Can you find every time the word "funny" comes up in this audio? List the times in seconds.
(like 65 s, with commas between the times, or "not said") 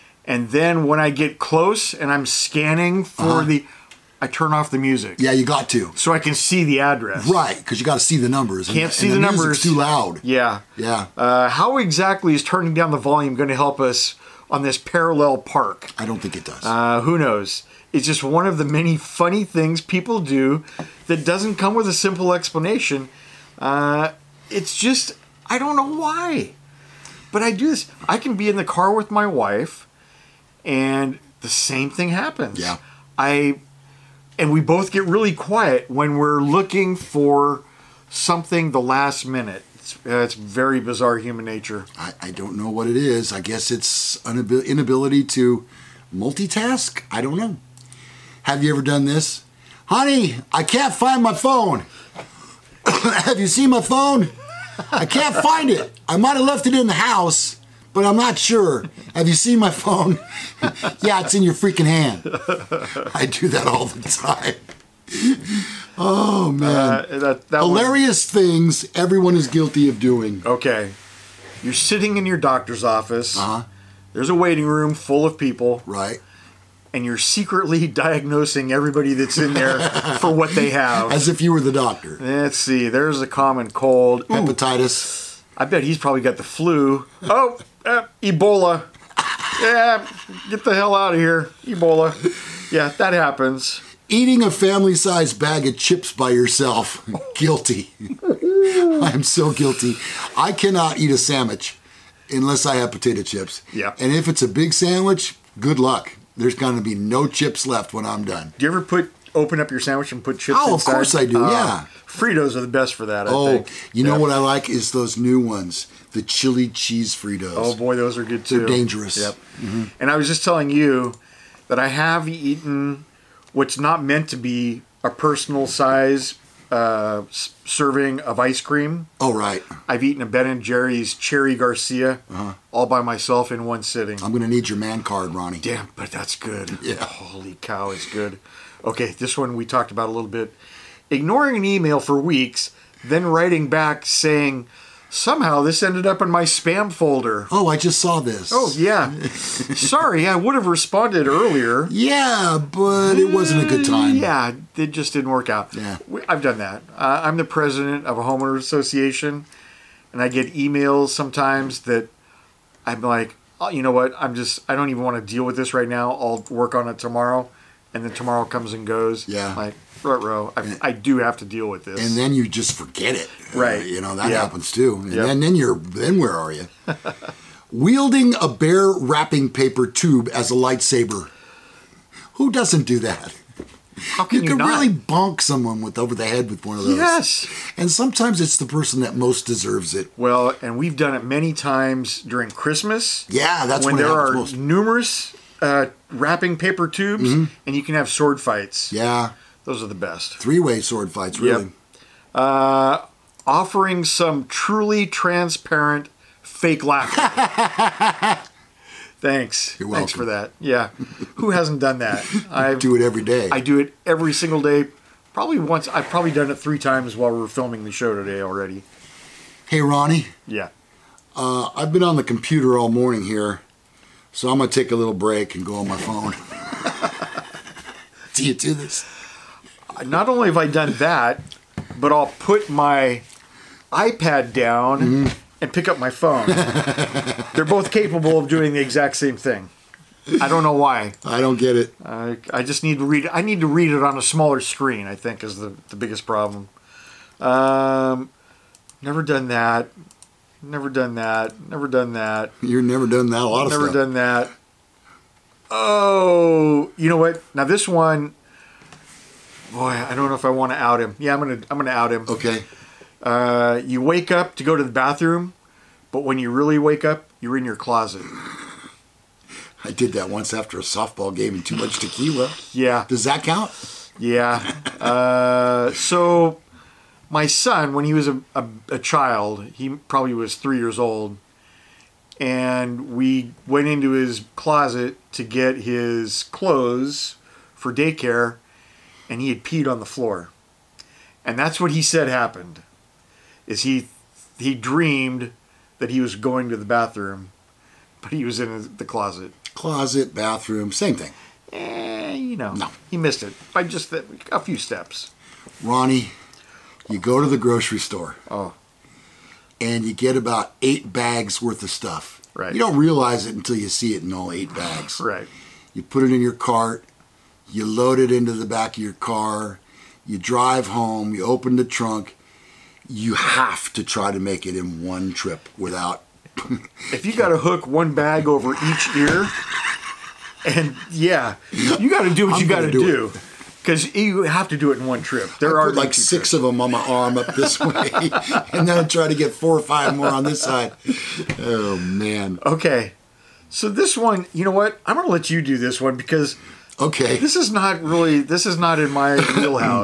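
18 s.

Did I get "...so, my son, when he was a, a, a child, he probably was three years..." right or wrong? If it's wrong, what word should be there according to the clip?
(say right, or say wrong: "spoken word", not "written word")
right.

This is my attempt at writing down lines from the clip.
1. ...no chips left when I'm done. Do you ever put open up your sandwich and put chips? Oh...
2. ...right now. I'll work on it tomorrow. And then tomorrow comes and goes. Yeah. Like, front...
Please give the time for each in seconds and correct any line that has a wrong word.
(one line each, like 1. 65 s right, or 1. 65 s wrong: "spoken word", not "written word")
1. 106 s right
2. 165 s right.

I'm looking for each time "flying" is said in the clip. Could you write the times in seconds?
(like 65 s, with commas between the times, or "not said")
not said.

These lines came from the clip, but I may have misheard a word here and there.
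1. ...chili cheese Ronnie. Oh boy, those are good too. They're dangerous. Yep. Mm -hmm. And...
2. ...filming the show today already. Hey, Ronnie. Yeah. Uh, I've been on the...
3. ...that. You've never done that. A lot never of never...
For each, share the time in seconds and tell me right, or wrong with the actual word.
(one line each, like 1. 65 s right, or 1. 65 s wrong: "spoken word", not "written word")
1. 116 s wrong: "Fritos", not "Ronnie"
2. 217 s right
3. 252 s right.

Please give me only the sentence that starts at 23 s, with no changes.
Uh, it's just, I don't know why.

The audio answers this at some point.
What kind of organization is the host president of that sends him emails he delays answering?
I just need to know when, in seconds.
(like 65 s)
158 s.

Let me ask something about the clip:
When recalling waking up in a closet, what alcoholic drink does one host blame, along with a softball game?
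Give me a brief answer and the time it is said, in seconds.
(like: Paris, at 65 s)
tequila, at 271 s.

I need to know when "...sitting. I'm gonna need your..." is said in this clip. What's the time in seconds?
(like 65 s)
133 s.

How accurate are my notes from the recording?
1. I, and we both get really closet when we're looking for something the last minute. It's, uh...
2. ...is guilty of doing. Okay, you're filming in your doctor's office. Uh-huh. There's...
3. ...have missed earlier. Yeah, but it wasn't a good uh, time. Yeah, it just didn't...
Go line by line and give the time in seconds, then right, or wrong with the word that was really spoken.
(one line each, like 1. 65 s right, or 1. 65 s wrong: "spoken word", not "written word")
1. 33 s wrong: "quiet", not "closet"
2. 69 s wrong: "sitting", not "filming"
3. 150 s wrong: "responded", not "missed".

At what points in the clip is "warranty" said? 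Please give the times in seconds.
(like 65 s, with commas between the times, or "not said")
not said.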